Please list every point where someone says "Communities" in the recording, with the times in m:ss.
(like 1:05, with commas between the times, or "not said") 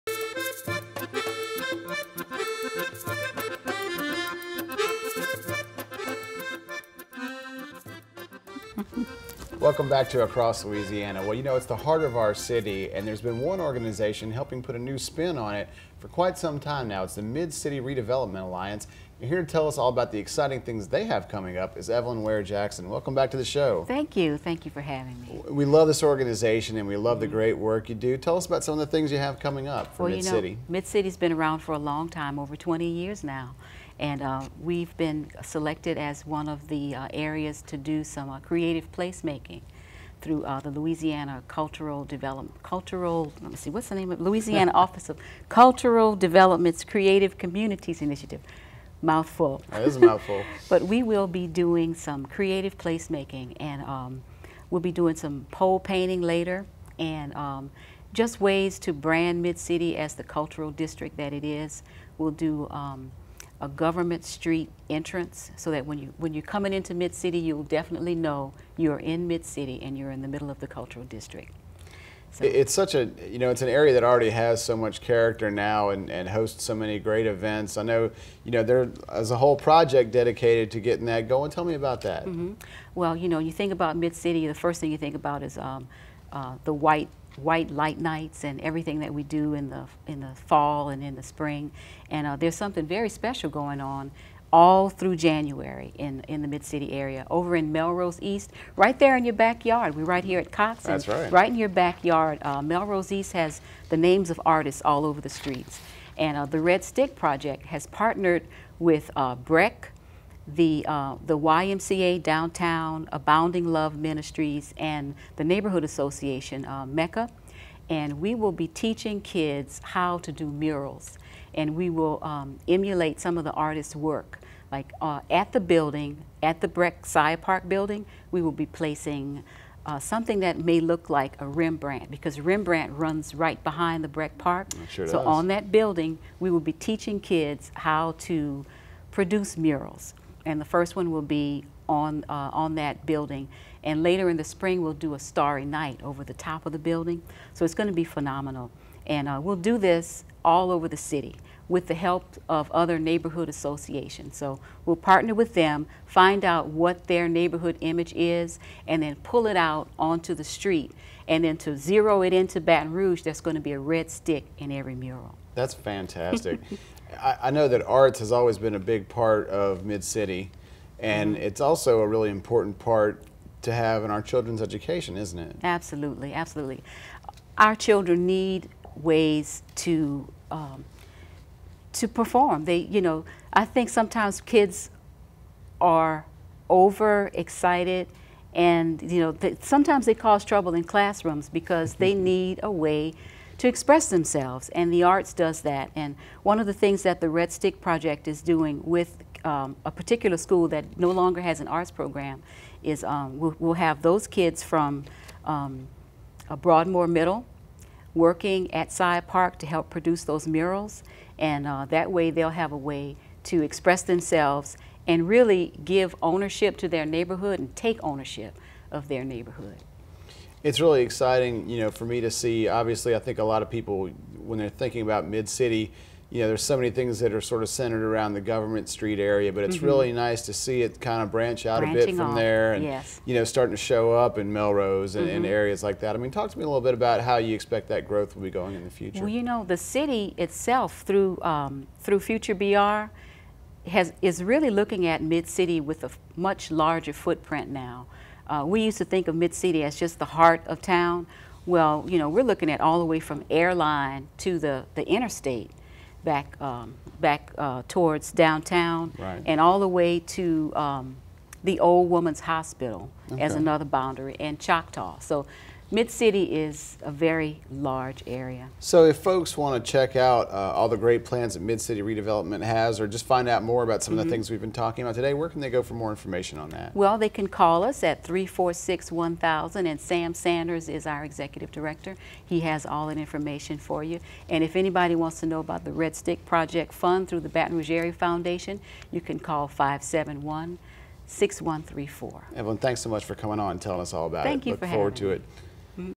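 0:47.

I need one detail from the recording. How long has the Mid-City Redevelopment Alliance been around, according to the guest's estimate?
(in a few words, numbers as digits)
over 20 years.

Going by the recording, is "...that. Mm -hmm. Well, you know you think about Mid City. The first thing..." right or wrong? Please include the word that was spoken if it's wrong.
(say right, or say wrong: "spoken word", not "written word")
right.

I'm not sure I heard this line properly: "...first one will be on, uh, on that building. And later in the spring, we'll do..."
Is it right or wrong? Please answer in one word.
right.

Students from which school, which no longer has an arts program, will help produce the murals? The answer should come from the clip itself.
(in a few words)
Broadmoor Middle.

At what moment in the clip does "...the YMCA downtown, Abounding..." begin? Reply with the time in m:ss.
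1:51.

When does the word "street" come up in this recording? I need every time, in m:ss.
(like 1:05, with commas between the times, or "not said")
1:04, 1:45, 2:40, 3:48.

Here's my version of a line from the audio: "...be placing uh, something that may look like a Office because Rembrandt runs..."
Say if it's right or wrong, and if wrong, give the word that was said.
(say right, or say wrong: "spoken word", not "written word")
wrong: "Rembrandt", not "Office".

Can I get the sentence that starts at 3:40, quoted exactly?
It's really exciting, you know, for me to see.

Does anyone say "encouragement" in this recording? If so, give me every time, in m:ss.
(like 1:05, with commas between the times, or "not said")
not said.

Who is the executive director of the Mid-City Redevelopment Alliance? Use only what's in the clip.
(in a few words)
Sam Sanders.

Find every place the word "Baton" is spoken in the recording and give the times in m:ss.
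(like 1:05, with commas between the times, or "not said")
2:42, 4:47.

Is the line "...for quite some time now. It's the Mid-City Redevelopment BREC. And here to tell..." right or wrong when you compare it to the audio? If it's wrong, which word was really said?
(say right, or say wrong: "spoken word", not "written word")
wrong: "Alliance", not "BREC".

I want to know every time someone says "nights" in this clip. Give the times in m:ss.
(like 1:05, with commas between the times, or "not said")
1:27, 2:25.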